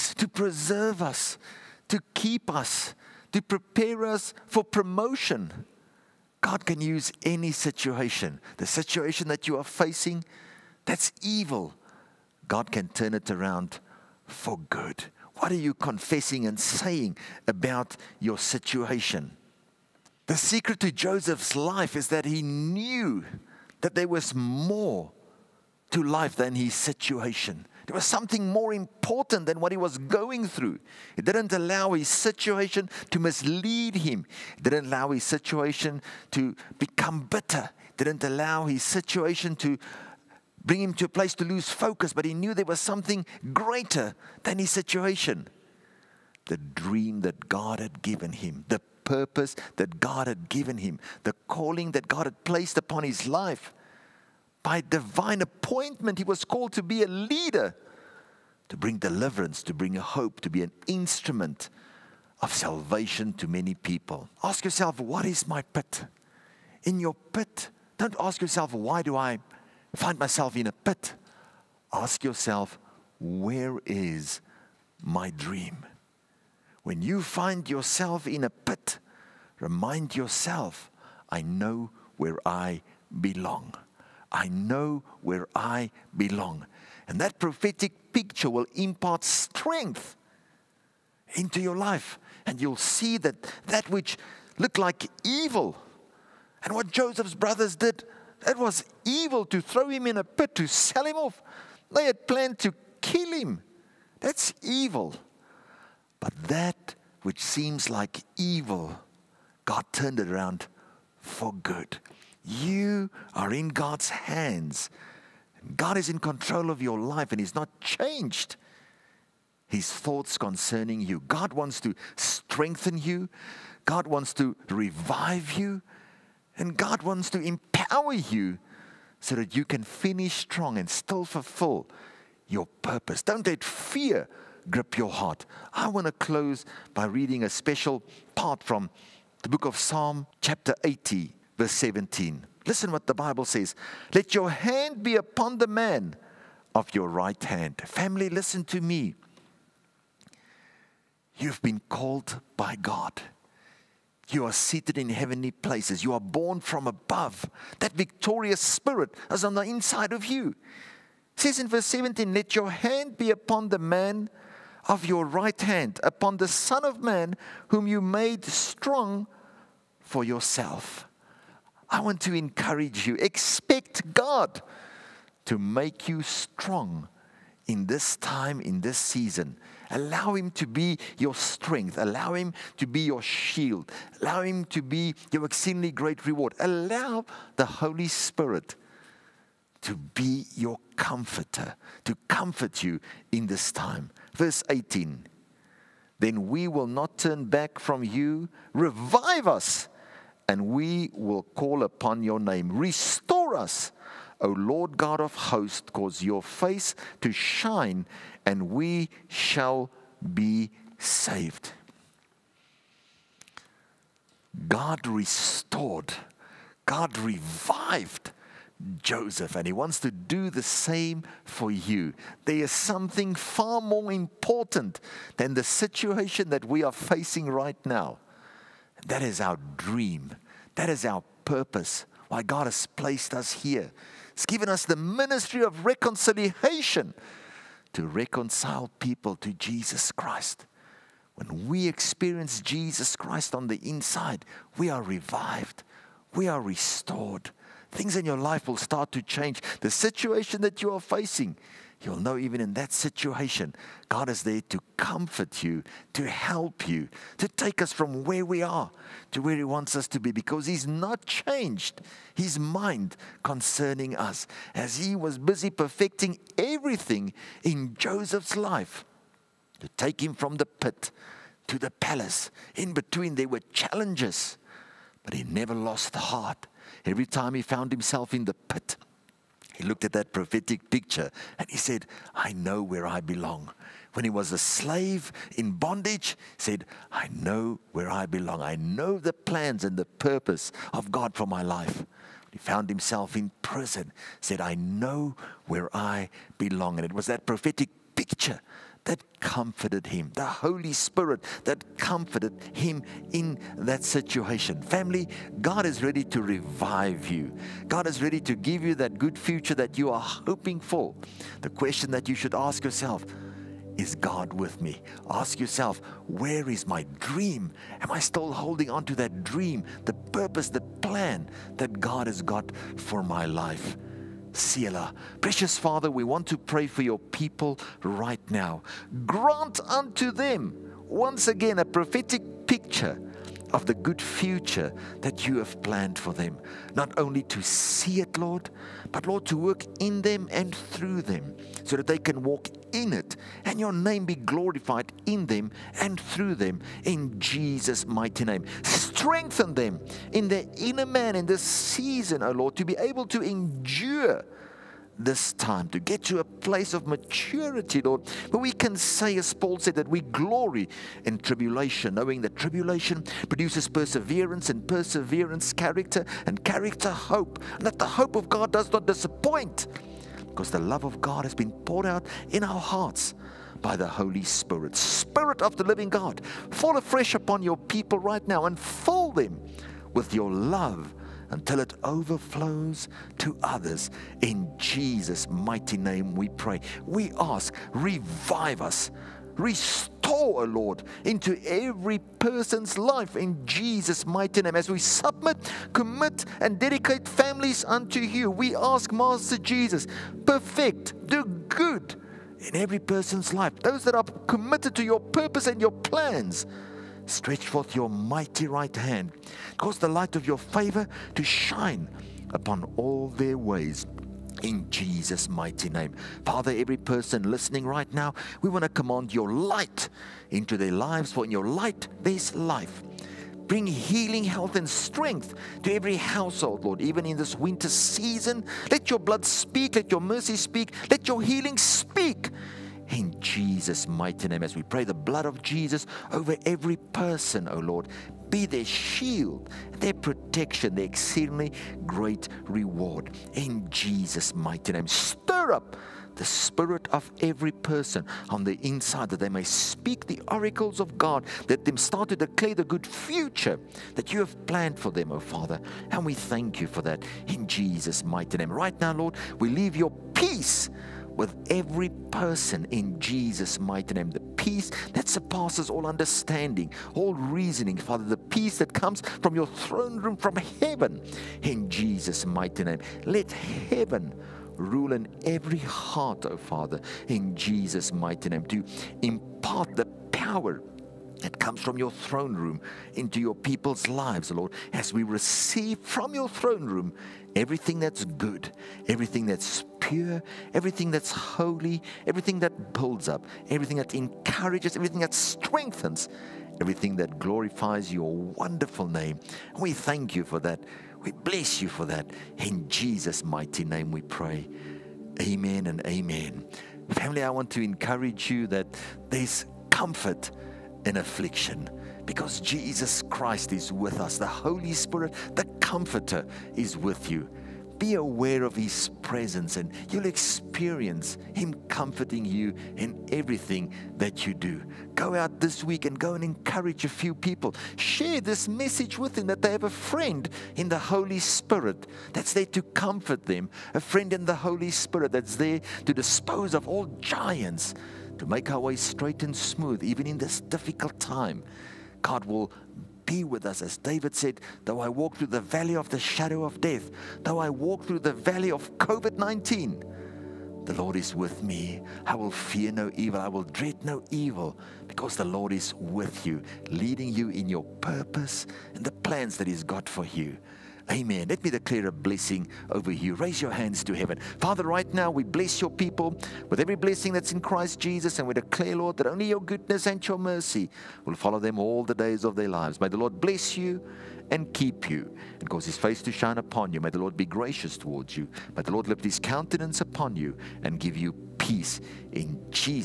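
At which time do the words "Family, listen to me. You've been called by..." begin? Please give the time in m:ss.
2:27.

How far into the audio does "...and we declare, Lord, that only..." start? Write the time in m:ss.
9:28.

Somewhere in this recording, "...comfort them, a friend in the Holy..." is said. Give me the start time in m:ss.
8:52.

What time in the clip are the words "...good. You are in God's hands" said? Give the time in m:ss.
1:51.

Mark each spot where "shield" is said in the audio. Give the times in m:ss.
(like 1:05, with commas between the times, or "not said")
3:03, 7:18.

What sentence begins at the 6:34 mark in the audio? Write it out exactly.
As we submit, commit, and dedicate families unto you, we ask, Master Jesus, perfect, do good in every person's life.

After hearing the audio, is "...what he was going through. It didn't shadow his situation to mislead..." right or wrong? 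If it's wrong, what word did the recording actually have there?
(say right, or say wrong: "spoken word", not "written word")
wrong: "allow", not "shadow".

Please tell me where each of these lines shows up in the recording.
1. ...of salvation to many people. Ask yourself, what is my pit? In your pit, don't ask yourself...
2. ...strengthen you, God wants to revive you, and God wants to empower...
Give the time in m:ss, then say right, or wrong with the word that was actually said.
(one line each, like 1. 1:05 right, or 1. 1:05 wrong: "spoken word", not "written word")
1. 1:02 right
2. 2:02 right.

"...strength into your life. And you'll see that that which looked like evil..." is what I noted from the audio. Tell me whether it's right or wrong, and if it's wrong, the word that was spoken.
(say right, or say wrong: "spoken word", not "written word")
right.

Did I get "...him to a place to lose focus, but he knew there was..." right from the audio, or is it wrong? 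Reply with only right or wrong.
right.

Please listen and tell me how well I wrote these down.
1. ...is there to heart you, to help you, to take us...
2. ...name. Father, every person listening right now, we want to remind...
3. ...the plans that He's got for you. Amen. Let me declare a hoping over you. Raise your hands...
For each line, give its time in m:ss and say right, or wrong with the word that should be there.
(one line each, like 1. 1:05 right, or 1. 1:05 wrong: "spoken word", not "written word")
1. 4:14 wrong: "comfort", not "heart"
2. 6:55 wrong: "command", not "remind"
3. 9:19 wrong: "blessing", not "hoping".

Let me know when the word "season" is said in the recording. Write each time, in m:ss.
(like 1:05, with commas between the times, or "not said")
2:58, 5:51, 7:07.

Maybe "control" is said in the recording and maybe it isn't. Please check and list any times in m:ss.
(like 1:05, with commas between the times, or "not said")
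1:56.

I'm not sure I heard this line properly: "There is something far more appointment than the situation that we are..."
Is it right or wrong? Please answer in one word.
wrong.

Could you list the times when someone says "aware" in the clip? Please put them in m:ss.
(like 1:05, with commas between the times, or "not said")
8:38.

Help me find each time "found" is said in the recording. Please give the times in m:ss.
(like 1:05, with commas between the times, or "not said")
4:37, 4:52.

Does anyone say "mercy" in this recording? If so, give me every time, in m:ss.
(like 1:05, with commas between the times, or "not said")
7:10, 9:30.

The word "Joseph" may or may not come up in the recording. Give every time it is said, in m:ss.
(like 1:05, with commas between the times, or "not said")
0:20, 1:36, 3:39, 4:27.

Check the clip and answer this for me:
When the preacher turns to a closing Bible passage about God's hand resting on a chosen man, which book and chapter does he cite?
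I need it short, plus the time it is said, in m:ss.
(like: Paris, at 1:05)
Psalm 80, at 2:19.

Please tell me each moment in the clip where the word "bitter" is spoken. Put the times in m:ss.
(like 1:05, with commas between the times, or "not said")
0:37.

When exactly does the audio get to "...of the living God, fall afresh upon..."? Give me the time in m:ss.
6:15.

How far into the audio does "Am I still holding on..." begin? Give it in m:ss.
5:17.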